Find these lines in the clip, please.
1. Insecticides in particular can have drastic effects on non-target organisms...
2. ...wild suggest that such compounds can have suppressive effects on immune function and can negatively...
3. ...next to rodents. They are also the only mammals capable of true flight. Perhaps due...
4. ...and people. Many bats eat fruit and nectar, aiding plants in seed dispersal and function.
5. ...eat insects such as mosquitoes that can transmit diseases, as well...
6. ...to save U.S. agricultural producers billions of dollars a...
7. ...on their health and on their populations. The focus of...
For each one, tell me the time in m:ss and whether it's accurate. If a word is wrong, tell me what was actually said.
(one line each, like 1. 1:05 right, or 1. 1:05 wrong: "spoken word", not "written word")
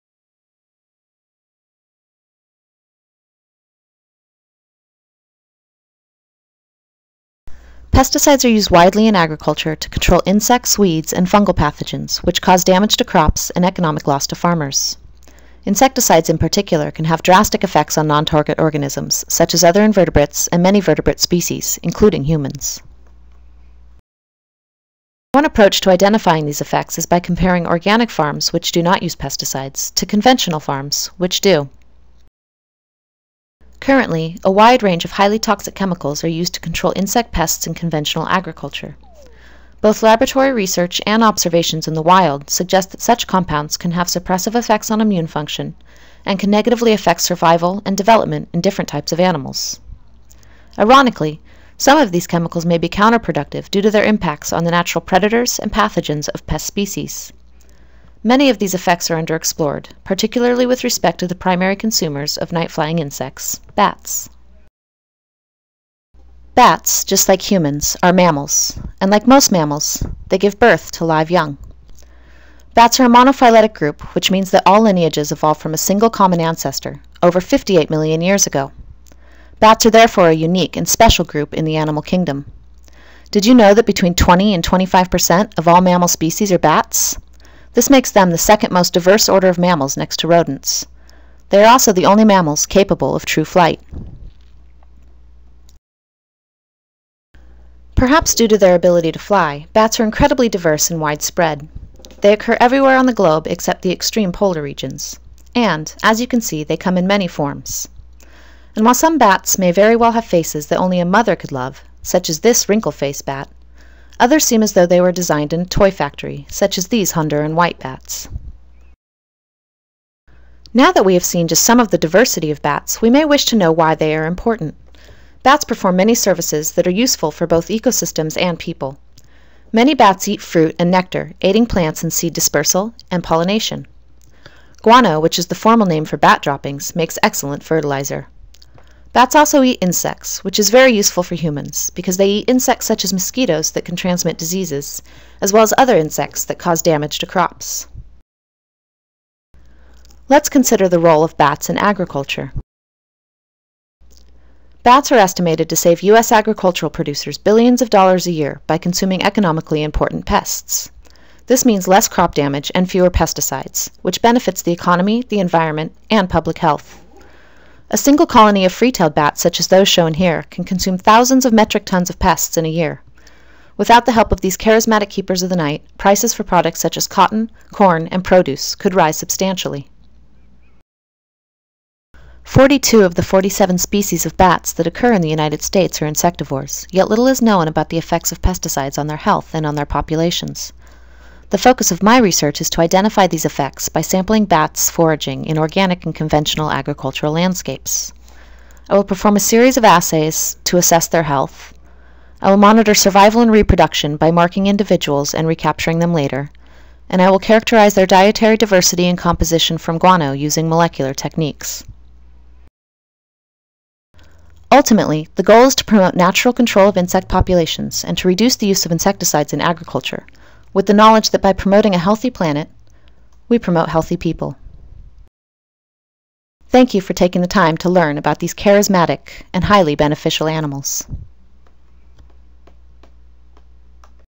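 1. 0:15 right
2. 0:42 right
3. 1:29 right
4. 2:08 wrong: "pollination", not "function"
5. 2:22 right
6. 2:35 right
7. 3:08 right.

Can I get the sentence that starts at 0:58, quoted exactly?
Many of these effects are underexplored, particularly with respect to the primary consumers of night flying insects, bats.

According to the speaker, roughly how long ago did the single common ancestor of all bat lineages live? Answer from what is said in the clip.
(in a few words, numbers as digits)
over 58 million years ago.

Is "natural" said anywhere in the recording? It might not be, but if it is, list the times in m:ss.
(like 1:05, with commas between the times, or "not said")
0:54, 3:36.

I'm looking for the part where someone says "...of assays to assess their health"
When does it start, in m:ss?
3:19.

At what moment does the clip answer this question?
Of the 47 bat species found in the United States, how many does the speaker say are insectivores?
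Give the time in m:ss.
3:02.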